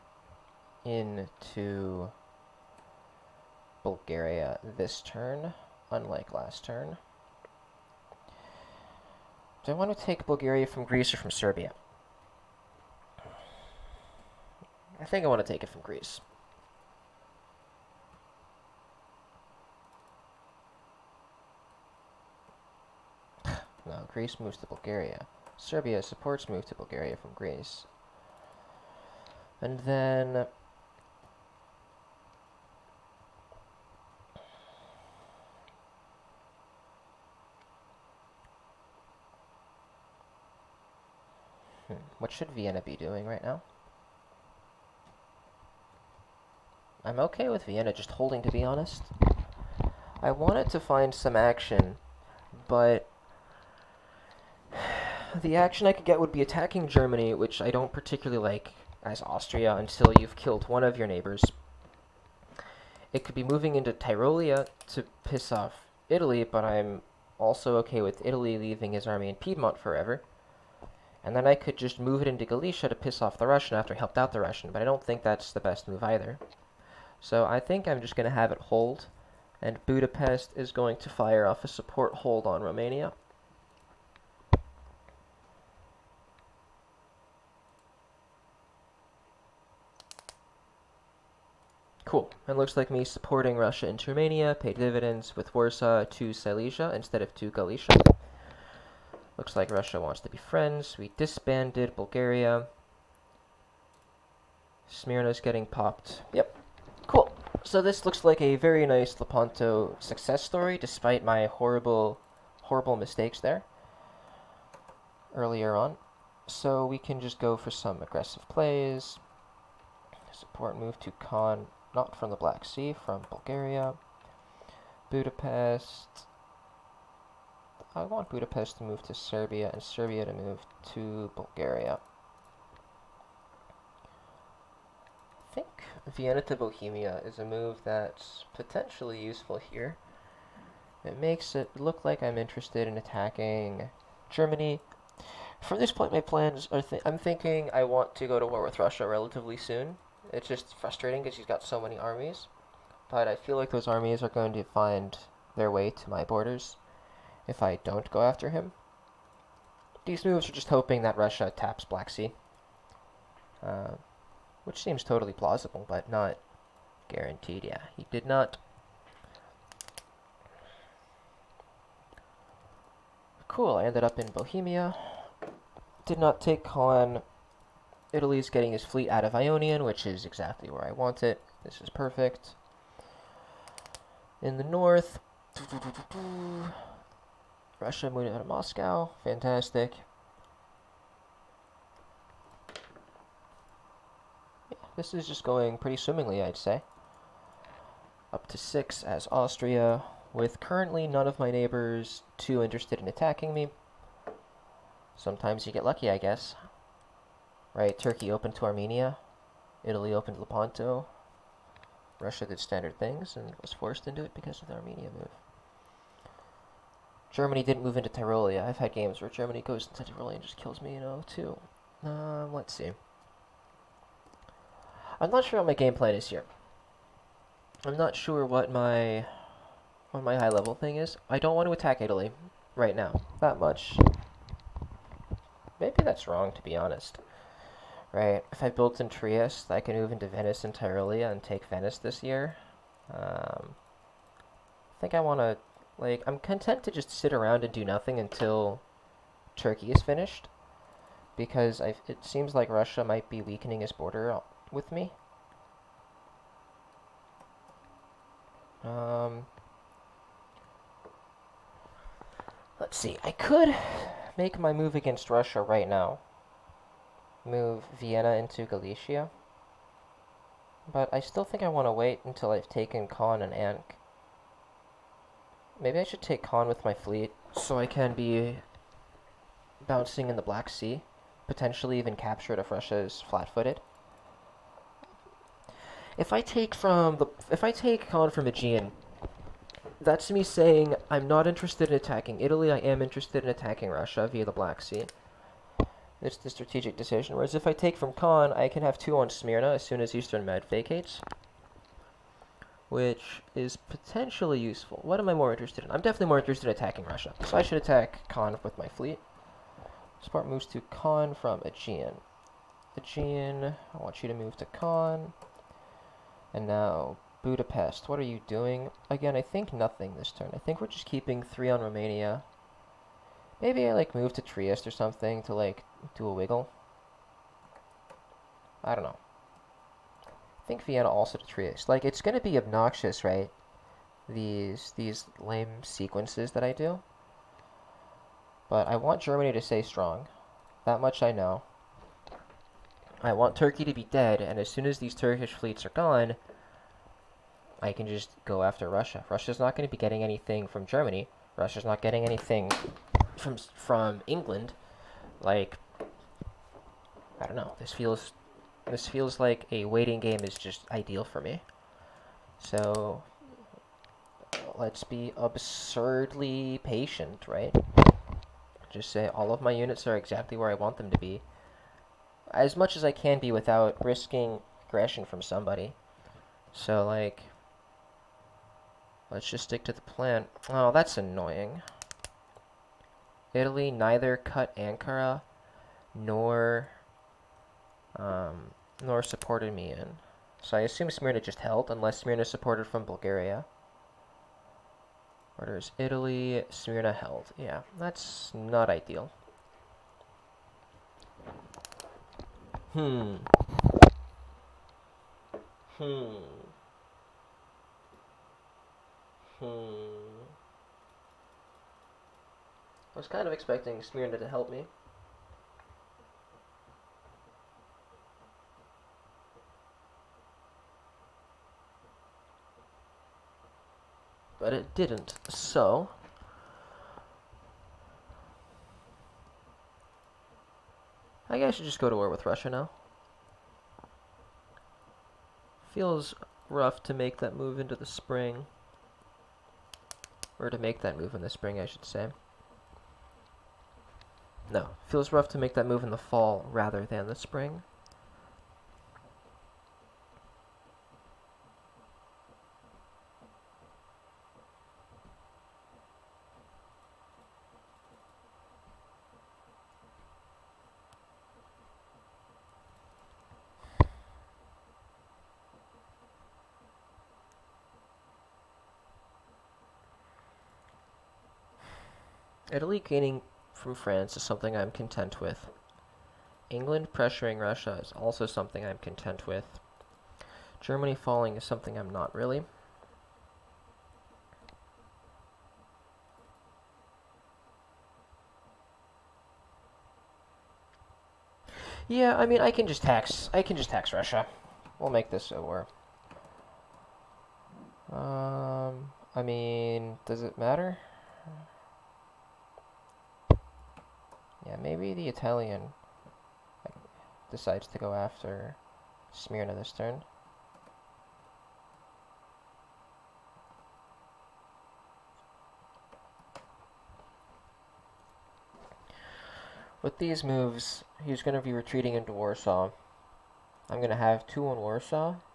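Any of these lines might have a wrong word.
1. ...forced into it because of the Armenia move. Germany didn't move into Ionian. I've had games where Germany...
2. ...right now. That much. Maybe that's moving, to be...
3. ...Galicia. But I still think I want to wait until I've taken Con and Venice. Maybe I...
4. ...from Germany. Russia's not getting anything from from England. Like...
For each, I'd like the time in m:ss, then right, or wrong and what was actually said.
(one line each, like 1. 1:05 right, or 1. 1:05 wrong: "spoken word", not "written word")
1. 3:33 wrong: "Tyrolia", not "Ionian"
2. 3:52 wrong: "wrong", not "moving"
3. 4:28 wrong: "Ank", not "Venice"
4. 5:50 right.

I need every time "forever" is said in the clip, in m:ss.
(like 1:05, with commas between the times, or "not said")
1:09.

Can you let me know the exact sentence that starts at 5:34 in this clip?
These, these lame sequences that I do.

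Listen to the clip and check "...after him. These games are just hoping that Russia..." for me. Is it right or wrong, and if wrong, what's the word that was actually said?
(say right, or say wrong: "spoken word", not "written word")
wrong: "moves", not "games".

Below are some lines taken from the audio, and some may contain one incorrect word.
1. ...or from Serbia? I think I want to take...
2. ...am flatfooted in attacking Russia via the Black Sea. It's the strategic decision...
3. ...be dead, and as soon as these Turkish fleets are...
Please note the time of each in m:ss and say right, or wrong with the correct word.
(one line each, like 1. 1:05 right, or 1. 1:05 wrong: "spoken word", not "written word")
1. 0:11 right
2. 4:52 wrong: "interested", not "flatfooted"
3. 5:43 right.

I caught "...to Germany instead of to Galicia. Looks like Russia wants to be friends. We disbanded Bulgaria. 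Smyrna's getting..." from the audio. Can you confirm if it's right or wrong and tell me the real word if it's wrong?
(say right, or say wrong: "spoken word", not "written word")
wrong: "Silesia", not "Germany".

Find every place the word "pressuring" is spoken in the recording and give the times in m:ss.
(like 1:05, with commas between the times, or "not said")
7:57.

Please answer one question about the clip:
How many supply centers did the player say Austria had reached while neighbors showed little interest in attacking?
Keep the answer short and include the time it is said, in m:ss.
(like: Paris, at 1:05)
6, at 3:18.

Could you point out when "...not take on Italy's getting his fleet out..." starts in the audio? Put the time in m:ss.
2:56.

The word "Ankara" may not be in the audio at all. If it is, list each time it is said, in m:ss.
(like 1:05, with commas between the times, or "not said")
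6:24.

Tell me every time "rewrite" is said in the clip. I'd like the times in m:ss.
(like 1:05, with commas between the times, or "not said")
not said.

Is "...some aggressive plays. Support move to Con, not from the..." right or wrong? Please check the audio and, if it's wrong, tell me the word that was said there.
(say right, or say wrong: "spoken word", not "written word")
right.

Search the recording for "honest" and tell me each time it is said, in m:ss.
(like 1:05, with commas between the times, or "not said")
0:48, 3:56.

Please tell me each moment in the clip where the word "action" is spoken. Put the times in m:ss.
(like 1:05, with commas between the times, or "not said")
0:51, 0:55.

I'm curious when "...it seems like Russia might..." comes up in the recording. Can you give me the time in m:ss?
4:12.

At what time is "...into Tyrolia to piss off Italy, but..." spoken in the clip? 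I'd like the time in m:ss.
1:03.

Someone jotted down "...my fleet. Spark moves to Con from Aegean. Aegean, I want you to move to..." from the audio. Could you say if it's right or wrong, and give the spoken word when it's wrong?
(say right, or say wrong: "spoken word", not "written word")
right.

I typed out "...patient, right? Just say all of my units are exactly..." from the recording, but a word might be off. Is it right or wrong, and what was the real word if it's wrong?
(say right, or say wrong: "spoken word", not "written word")
right.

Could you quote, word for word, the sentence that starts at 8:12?
Yeah, I mean, I can just tax.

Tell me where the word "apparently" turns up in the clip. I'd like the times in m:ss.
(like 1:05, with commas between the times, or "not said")
not said.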